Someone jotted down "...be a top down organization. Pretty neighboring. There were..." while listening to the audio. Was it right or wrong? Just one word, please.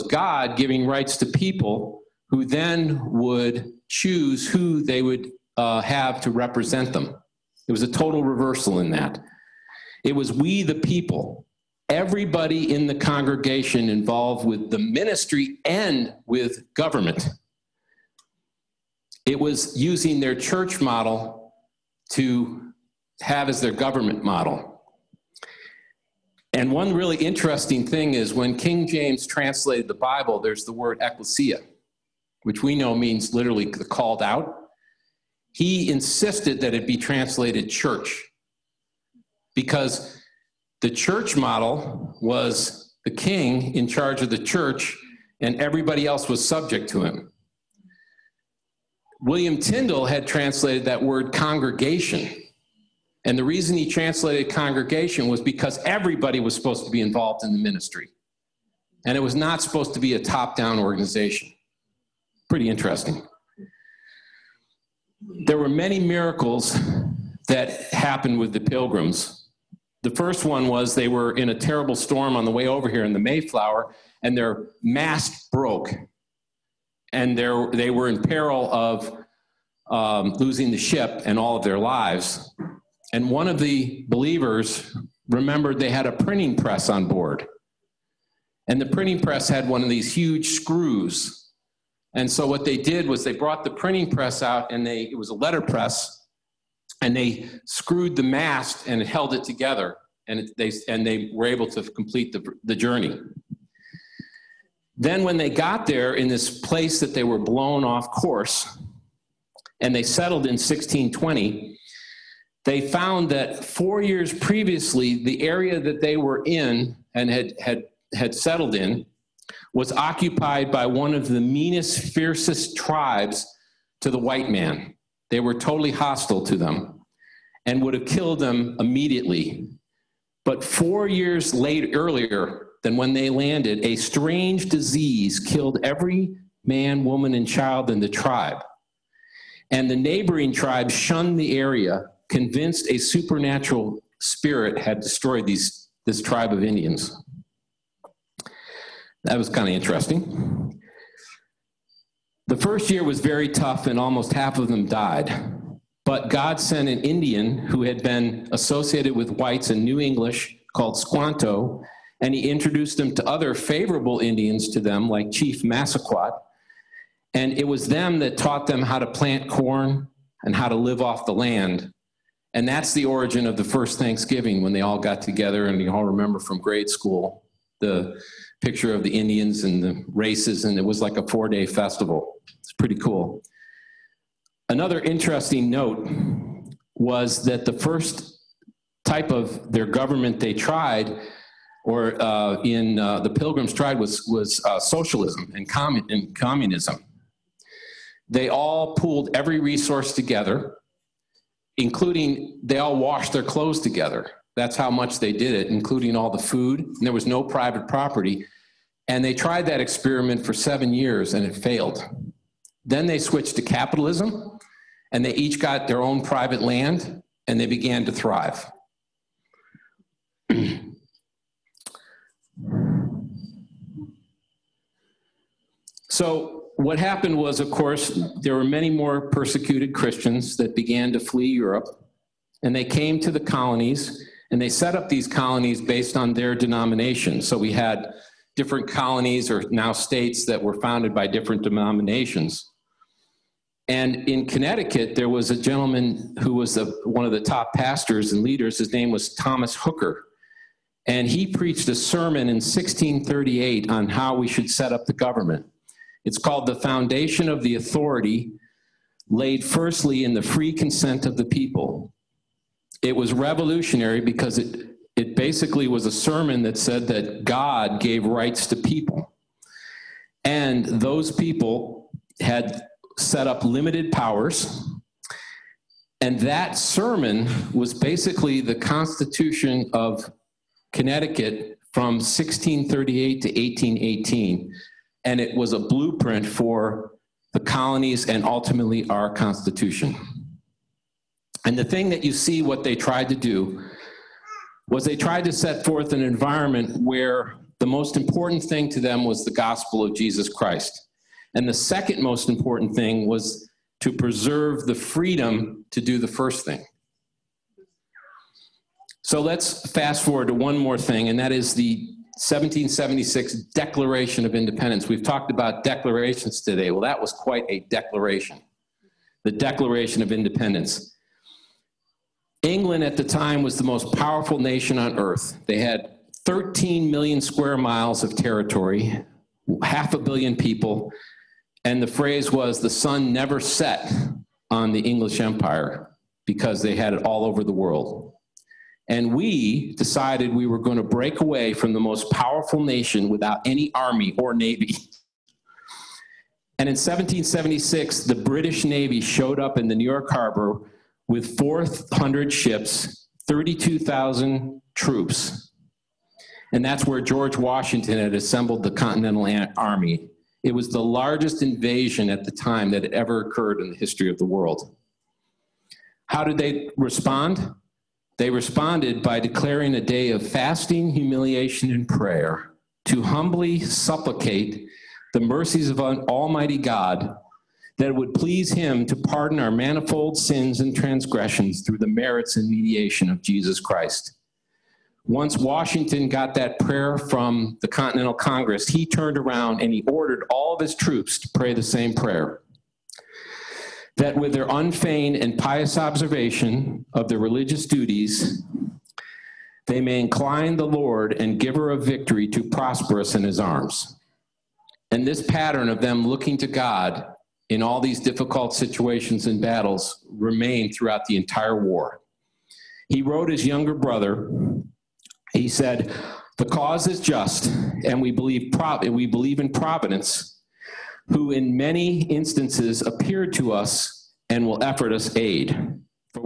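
wrong.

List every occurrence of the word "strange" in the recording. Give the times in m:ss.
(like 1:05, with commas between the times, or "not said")
2:13.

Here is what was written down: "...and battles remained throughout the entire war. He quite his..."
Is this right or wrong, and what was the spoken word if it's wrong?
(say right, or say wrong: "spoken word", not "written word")
wrong: "wrote", not "quite".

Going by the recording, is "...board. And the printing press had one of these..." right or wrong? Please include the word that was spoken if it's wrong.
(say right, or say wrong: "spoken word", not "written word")
right.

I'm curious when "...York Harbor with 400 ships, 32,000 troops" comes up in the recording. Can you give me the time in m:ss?
5:50.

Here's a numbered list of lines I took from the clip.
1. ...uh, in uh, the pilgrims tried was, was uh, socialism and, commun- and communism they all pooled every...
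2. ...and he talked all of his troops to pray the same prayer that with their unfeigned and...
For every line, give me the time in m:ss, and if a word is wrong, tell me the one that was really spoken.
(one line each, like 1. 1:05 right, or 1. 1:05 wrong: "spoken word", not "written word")
1. 3:12 right
2. 6:29 wrong: "ordered", not "talked".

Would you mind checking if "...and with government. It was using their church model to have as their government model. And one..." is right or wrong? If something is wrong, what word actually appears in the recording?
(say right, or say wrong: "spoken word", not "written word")
right.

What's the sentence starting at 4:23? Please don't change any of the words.
It was revolutionary because it, it basically was a sermon that said that God gave rights to people.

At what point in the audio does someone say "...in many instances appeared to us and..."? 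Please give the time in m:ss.
7:01.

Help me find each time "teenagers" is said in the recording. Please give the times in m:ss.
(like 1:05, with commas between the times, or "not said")
not said.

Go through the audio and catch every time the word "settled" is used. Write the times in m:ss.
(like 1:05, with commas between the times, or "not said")
1:50, 1:58.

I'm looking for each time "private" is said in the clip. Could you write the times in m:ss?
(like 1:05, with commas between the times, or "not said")
3:27, 3:36.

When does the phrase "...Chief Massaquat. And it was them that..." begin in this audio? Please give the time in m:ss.
2:45.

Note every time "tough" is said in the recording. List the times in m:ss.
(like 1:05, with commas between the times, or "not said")
2:33.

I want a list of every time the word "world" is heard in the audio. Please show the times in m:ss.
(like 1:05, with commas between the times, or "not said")
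5:37, 6:04.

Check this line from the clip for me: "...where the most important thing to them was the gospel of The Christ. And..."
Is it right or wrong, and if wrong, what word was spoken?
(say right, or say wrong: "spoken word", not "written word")
wrong: "Jesus", not "The".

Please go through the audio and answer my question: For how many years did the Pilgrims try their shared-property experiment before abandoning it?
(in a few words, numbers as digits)
7.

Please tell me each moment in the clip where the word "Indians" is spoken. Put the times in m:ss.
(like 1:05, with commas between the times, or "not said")
2:26, 2:37, 2:44, 2:59.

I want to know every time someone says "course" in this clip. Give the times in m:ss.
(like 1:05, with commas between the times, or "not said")
1:48, 3:47.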